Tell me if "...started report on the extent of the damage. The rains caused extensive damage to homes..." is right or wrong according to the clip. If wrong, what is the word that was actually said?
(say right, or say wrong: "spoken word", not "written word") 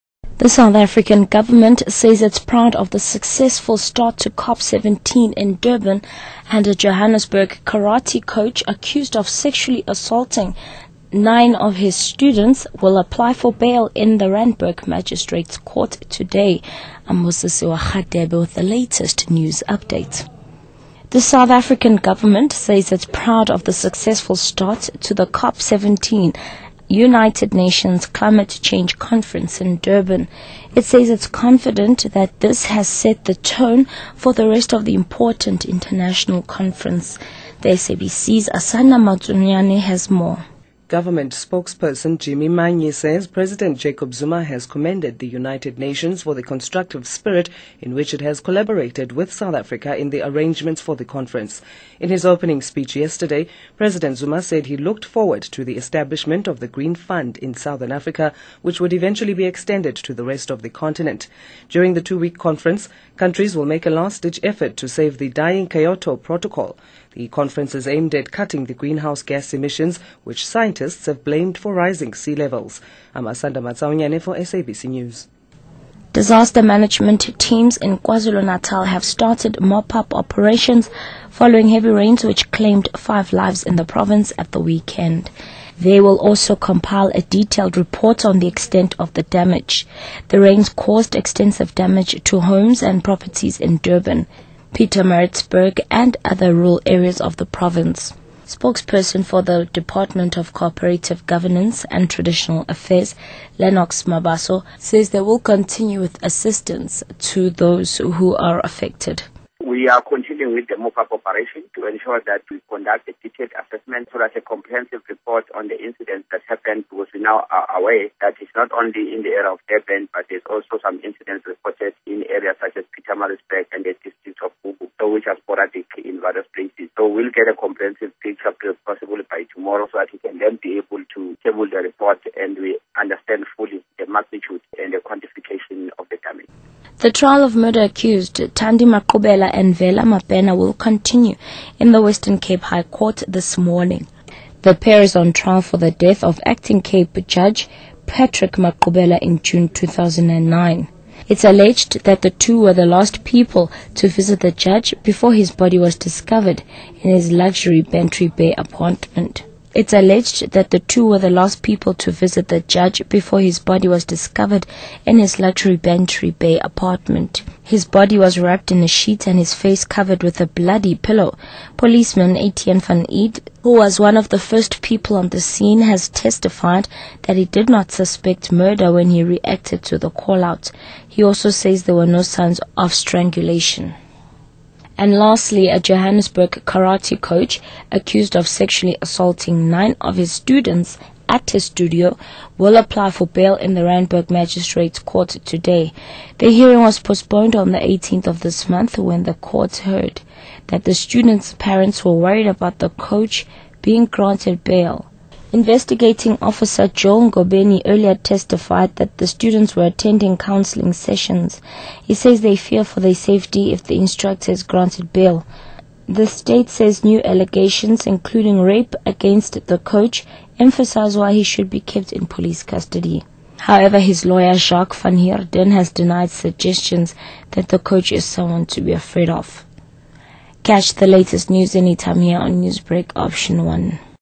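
wrong: "detailed", not "started".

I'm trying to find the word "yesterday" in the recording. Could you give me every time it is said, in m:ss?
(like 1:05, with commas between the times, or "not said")
0:52.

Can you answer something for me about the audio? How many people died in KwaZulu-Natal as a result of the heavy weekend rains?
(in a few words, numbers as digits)
5.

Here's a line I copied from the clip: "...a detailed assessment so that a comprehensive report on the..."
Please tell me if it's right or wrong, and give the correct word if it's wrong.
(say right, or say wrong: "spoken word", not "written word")
right.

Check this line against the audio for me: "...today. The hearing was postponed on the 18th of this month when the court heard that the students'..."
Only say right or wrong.
right.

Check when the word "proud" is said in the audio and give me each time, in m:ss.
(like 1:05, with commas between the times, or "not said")
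0:02, 0:23.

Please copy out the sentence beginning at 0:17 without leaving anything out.
Amosisiwa Khadebe with the latest news update.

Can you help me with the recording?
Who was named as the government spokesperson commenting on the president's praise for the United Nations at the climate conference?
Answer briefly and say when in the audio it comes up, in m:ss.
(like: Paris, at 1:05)
Jimmy Manyi, at 0:42.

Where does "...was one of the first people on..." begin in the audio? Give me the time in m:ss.
2:53.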